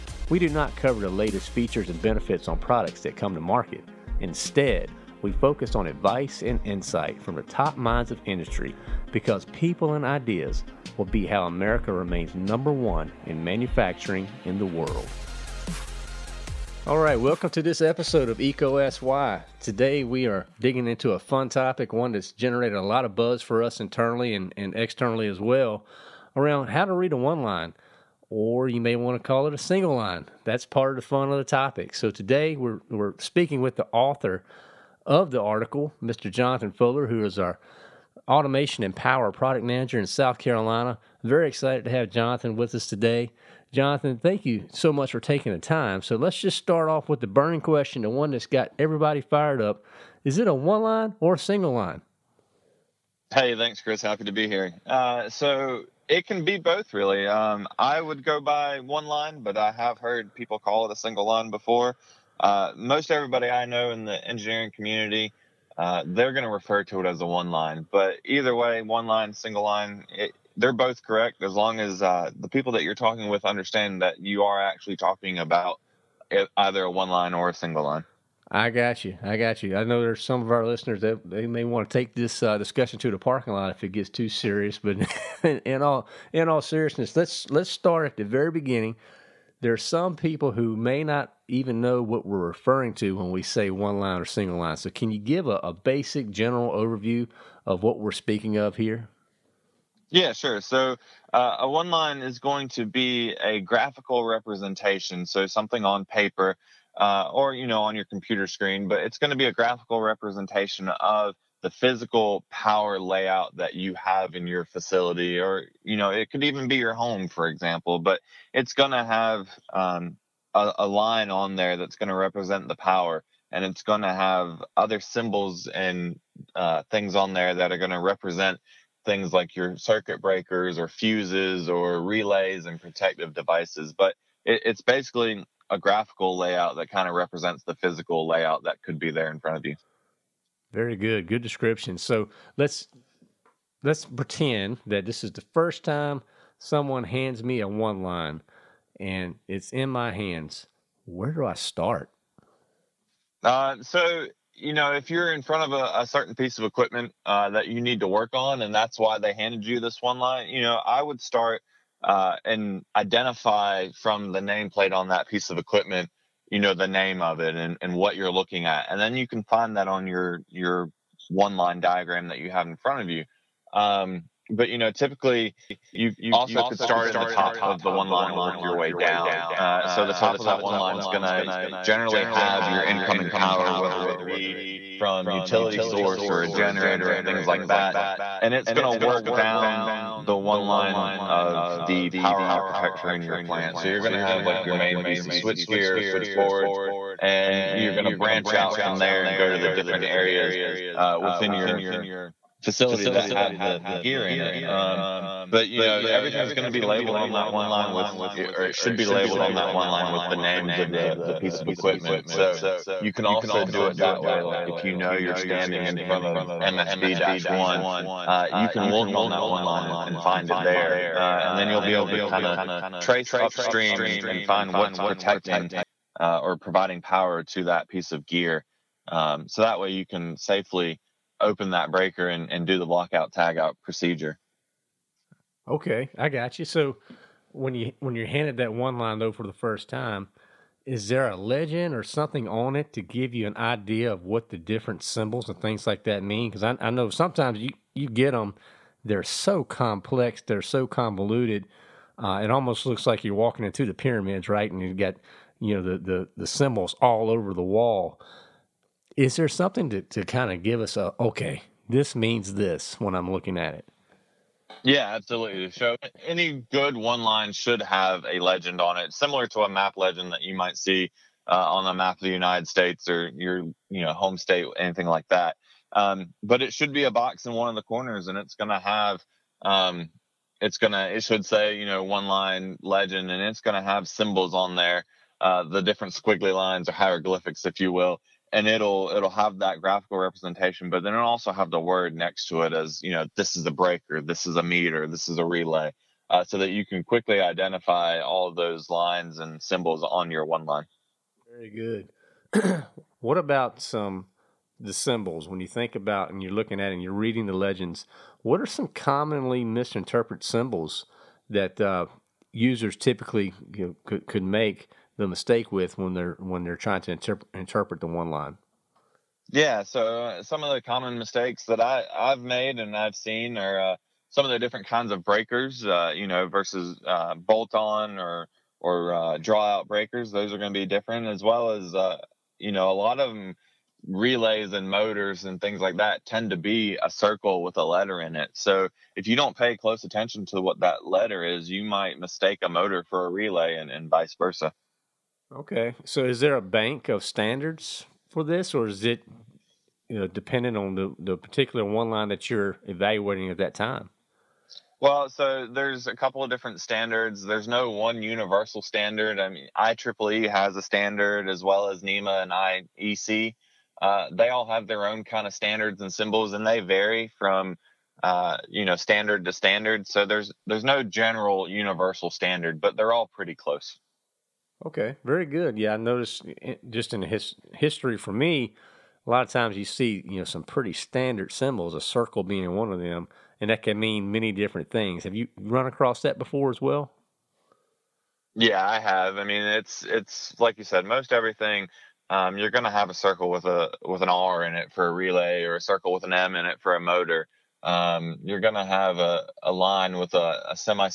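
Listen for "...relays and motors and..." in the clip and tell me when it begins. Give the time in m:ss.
5:34.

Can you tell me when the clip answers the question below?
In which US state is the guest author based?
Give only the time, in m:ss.
0:40.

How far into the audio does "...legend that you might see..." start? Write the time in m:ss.
4:29.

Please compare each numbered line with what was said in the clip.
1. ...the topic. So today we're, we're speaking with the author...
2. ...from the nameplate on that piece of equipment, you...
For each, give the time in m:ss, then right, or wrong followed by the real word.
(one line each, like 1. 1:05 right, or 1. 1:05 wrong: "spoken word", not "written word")
1. 0:31 right
2. 2:43 right.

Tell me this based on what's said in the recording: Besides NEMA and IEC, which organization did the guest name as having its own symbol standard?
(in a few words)
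IEEE.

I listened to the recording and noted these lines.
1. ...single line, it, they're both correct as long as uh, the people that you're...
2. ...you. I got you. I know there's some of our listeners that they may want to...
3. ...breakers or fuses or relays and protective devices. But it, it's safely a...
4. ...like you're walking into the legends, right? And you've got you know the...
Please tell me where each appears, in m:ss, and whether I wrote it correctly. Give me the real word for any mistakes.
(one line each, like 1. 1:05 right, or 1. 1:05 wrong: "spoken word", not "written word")
1. 1:09 right
2. 1:19 right
3. 2:10 wrong: "basically", not "safely"
4. 4:13 wrong: "pyramids", not "legends".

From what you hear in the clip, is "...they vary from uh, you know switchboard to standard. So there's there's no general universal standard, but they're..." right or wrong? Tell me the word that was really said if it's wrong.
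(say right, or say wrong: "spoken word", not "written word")
wrong: "standard", not "switchboard".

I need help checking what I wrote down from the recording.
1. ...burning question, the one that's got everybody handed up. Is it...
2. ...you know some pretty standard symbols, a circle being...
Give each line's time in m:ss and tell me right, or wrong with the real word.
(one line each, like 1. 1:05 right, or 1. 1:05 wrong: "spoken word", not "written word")
1. 0:47 wrong: "fired", not "handed"
2. 6:20 right.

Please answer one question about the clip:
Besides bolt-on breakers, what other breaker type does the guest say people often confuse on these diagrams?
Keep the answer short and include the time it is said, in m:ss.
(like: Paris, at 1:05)
draw out breakers, at 5:29.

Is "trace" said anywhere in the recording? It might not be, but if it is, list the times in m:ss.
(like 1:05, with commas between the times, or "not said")
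3:42.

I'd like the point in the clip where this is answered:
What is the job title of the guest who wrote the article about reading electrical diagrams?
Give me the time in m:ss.
0:38.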